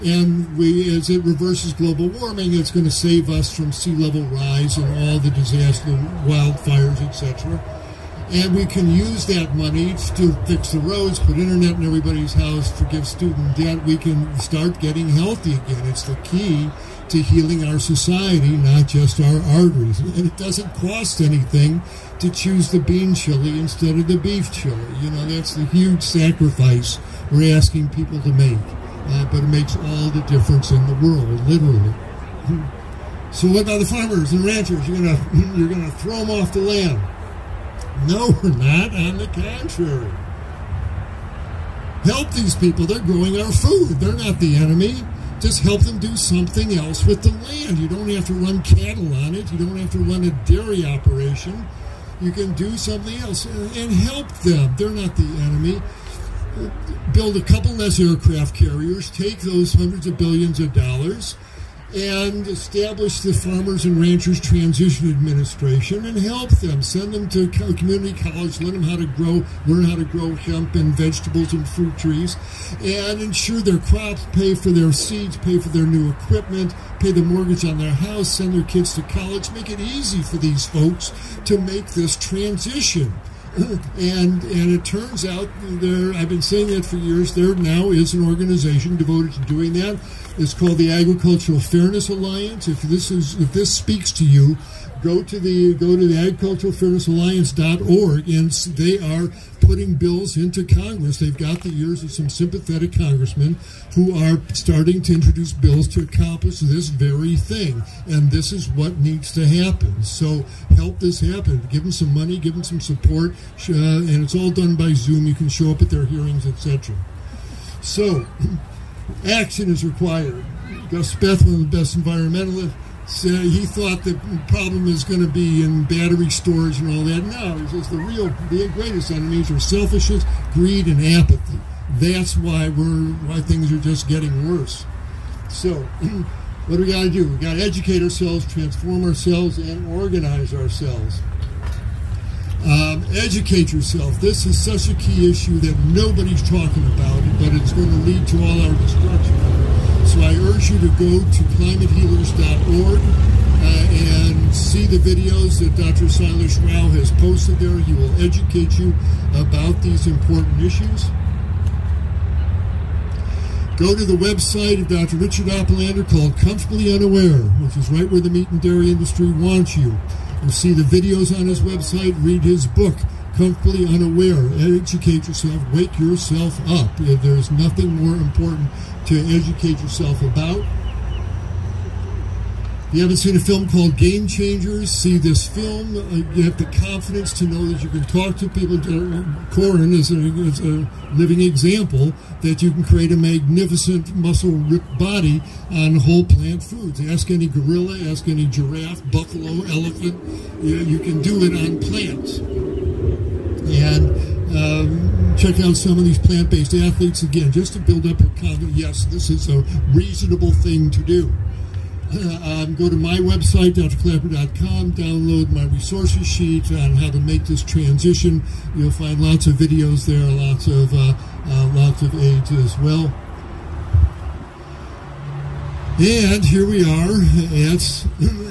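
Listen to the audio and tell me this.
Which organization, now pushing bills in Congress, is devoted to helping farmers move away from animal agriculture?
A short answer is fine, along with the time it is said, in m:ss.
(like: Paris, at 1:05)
Agricultural Fairness Alliance, at 1:30.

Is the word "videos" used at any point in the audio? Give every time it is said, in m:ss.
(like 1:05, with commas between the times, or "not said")
2:34, 2:50, 3:39.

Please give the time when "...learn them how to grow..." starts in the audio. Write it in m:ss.
1:08.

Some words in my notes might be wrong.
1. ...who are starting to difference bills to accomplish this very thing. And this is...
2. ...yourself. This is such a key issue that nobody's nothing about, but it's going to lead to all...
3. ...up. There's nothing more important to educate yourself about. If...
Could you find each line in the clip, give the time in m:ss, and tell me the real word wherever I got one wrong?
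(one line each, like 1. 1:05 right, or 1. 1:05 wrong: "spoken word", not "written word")
1. 1:43 wrong: "introduce", not "difference"
2. 2:23 wrong: "talking", not "nothing"
3. 2:56 right.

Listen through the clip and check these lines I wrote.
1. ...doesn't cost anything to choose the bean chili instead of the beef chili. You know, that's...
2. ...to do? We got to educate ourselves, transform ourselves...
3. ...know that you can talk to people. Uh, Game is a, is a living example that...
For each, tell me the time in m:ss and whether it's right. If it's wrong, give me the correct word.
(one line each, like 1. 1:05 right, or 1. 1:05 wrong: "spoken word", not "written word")
1. 0:20 right
2. 2:17 right
3. 3:07 wrong: "Corin", not "Game".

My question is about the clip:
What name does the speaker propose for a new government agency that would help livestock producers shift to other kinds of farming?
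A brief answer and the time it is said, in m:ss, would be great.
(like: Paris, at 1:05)
Farmers and Ranchers Transition Administration, at 1:03.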